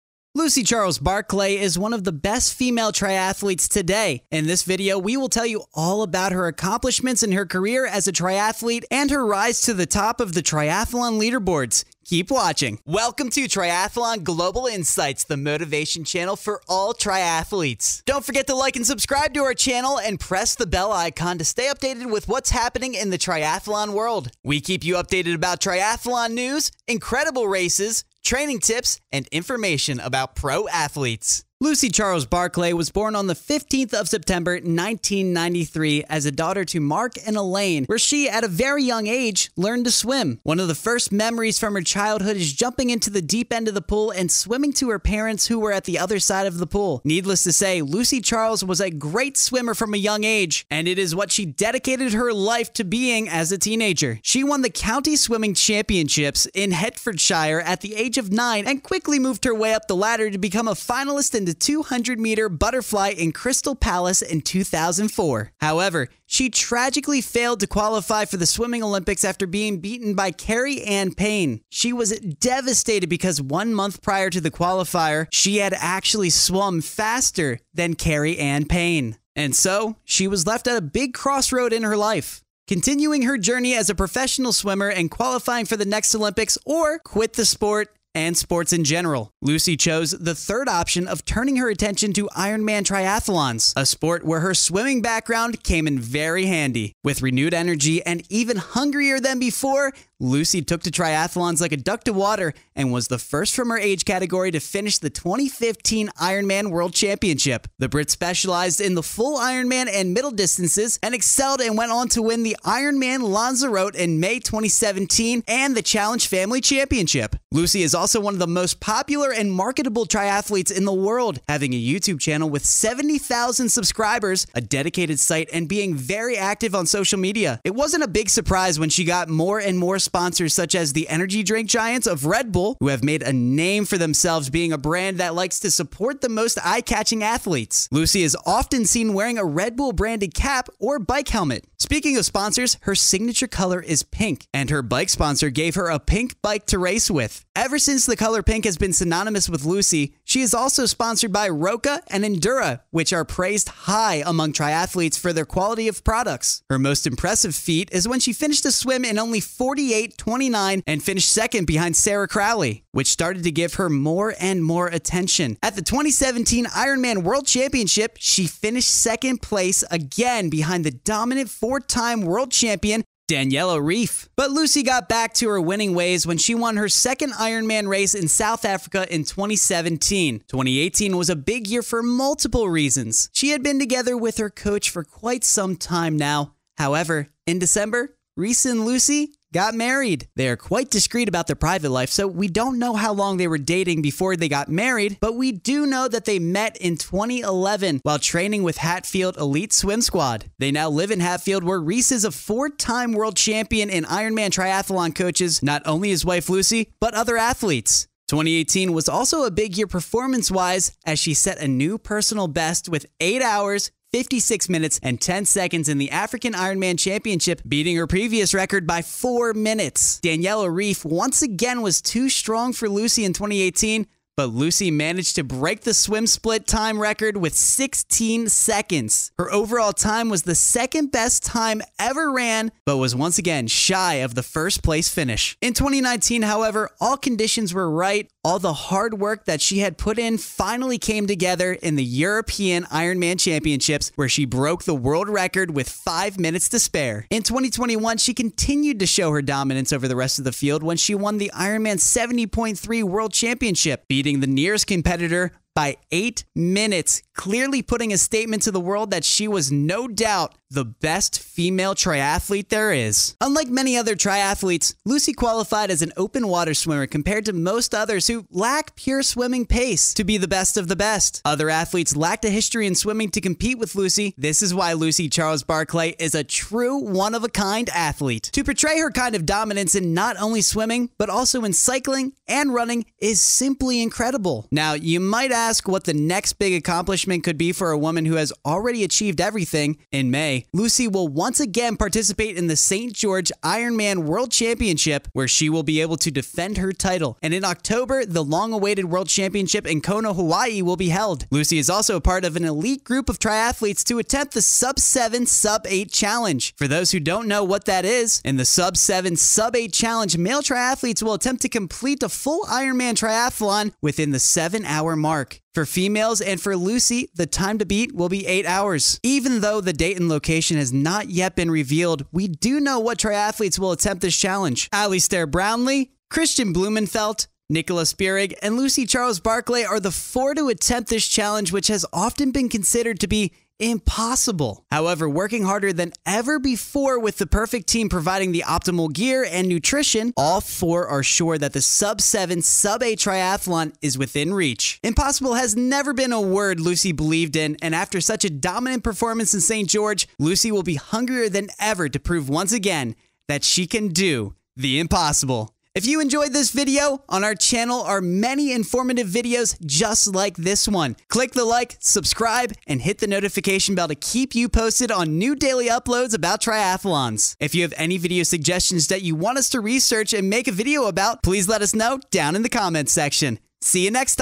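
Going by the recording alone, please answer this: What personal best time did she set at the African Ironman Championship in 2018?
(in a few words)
8 hours, 56 minutes and 10 seconds.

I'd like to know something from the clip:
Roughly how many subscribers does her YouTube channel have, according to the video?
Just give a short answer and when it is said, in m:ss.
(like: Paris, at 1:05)
70,000, at 2:02.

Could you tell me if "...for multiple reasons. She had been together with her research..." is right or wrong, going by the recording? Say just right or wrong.
wrong.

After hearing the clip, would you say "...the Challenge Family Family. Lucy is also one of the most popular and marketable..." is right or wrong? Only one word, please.
wrong.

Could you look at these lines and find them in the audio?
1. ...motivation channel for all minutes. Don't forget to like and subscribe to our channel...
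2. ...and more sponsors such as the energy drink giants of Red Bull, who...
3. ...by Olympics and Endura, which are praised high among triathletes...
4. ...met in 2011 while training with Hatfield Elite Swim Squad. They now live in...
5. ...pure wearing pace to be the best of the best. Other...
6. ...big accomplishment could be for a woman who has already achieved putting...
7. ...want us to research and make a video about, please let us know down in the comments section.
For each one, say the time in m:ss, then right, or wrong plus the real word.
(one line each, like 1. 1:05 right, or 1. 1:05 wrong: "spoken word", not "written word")
1. 0:15 wrong: "triathletes", not "minutes"
2. 2:09 right
3. 2:31 wrong: "Roka", not "Olympics"
4. 3:16 right
5. 4:28 wrong: "swimming", not "wearing"
6. 4:46 wrong: "everything", not "putting"
7. 6:09 right.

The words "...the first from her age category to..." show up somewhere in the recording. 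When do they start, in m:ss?
1:43.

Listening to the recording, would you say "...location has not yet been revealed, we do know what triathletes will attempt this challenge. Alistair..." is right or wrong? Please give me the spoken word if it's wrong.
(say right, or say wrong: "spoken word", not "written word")
right.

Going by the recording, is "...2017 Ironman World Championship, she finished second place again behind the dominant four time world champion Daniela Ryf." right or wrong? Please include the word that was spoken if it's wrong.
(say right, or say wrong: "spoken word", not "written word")
right.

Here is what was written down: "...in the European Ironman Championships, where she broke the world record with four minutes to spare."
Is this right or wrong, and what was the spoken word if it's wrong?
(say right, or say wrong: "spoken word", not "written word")
wrong: "five", not "four".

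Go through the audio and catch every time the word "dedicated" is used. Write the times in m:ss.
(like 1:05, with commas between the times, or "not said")
0:51, 2:04.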